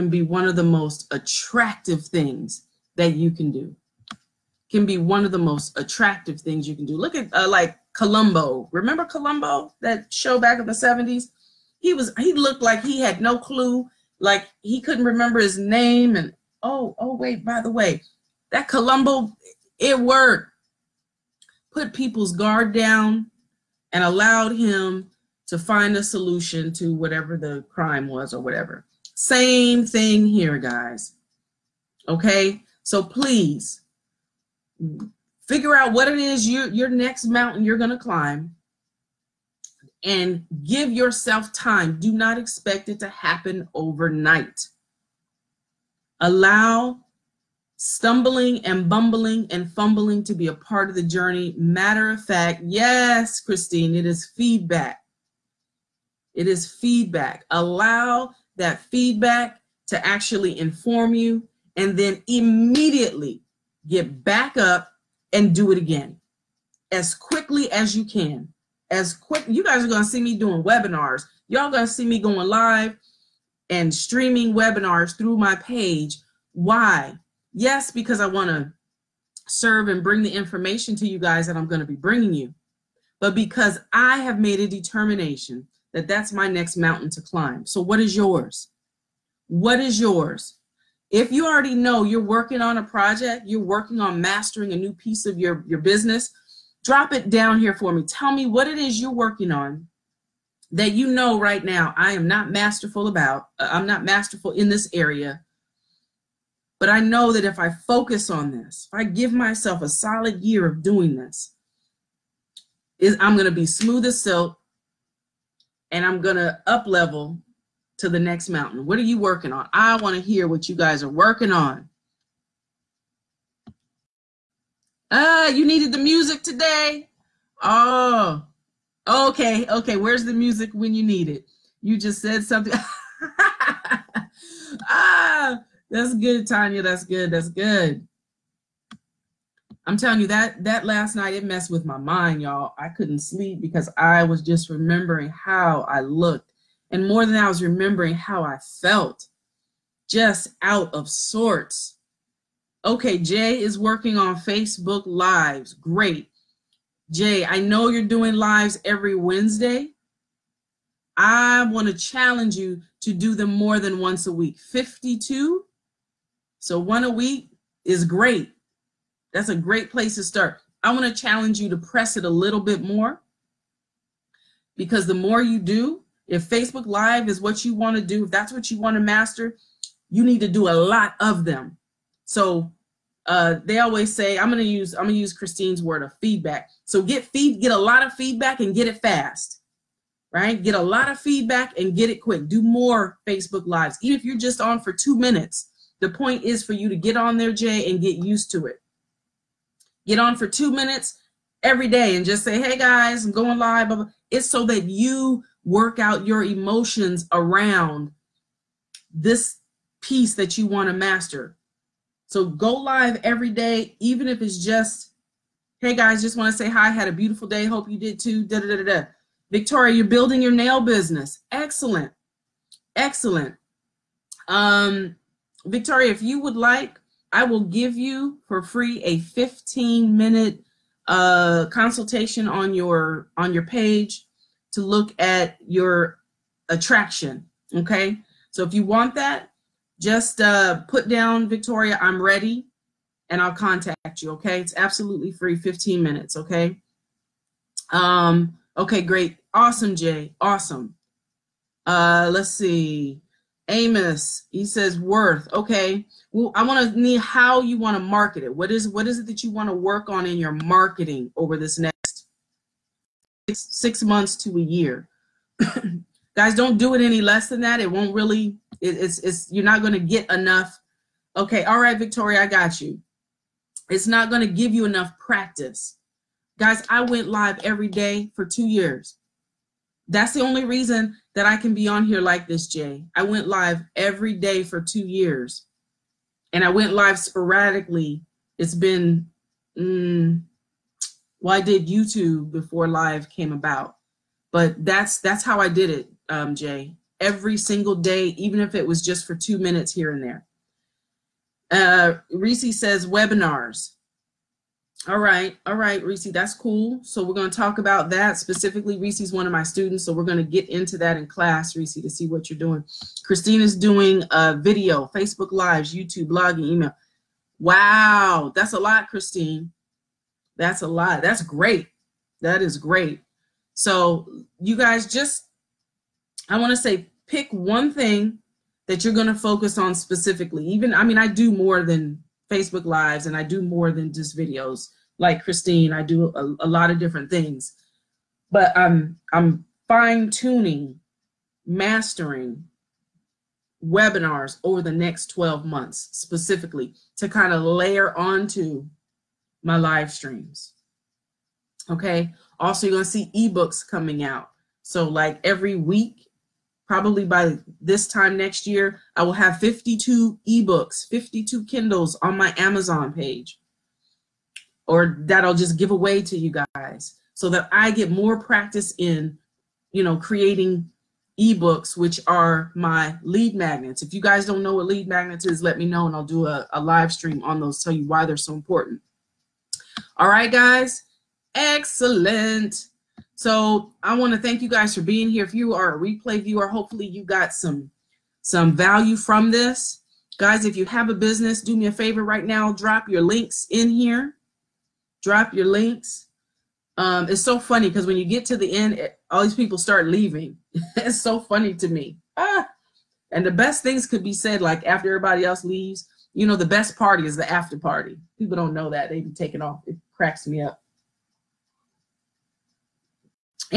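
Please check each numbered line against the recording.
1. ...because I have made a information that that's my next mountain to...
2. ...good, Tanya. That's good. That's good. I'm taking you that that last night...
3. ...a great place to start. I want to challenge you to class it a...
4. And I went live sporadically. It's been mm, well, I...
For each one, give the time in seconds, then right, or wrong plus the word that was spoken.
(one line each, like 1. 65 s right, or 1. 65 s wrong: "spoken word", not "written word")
1. 83 s wrong: "determination", not "information"
2. 136 s wrong: "telling", not "taking"
3. 169 s wrong: "press", not "class"
4. 286 s right.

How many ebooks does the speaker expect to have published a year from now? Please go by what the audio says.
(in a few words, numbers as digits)
52.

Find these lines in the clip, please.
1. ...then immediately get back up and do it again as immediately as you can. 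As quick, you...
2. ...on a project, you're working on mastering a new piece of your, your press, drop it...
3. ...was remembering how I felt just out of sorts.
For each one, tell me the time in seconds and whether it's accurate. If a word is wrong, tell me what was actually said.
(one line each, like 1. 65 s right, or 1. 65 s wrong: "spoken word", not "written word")
1. 61 s wrong: "quickly", not "immediately"
2. 92 s wrong: "business", not "press"
3. 147 s right.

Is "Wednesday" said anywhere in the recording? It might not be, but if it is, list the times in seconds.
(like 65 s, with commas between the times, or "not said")
159 s.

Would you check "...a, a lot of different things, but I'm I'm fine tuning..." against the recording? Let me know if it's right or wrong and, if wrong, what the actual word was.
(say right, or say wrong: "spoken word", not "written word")
right.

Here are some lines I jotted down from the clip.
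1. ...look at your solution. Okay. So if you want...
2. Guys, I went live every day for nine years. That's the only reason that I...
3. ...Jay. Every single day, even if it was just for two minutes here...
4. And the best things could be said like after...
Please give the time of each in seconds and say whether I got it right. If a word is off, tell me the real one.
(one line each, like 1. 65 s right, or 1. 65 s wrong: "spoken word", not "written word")
1. 234 s wrong: "attraction", not "solution"
2. 276 s wrong: "two", not "nine"
3. 296 s right
4. 403 s right.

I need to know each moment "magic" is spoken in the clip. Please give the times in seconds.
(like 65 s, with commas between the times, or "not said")
not said.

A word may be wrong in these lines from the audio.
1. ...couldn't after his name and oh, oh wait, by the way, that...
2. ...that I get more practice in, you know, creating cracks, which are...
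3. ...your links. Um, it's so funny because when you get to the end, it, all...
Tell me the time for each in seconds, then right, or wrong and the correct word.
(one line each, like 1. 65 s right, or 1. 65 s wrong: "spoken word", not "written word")
1. 14 s wrong: "remember", not "after"
2. 367 s wrong: "ebooks", not "cracks"
3. 395 s right.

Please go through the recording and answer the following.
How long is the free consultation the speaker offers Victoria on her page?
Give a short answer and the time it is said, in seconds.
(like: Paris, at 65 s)
15 minutes, at 229 s.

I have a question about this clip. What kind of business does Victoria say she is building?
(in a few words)
nail business.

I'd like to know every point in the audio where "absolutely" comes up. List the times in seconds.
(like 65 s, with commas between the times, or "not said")
244 s.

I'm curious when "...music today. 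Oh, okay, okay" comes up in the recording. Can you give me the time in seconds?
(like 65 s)
125 s.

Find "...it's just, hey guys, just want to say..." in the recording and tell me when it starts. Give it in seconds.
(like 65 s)
214 s.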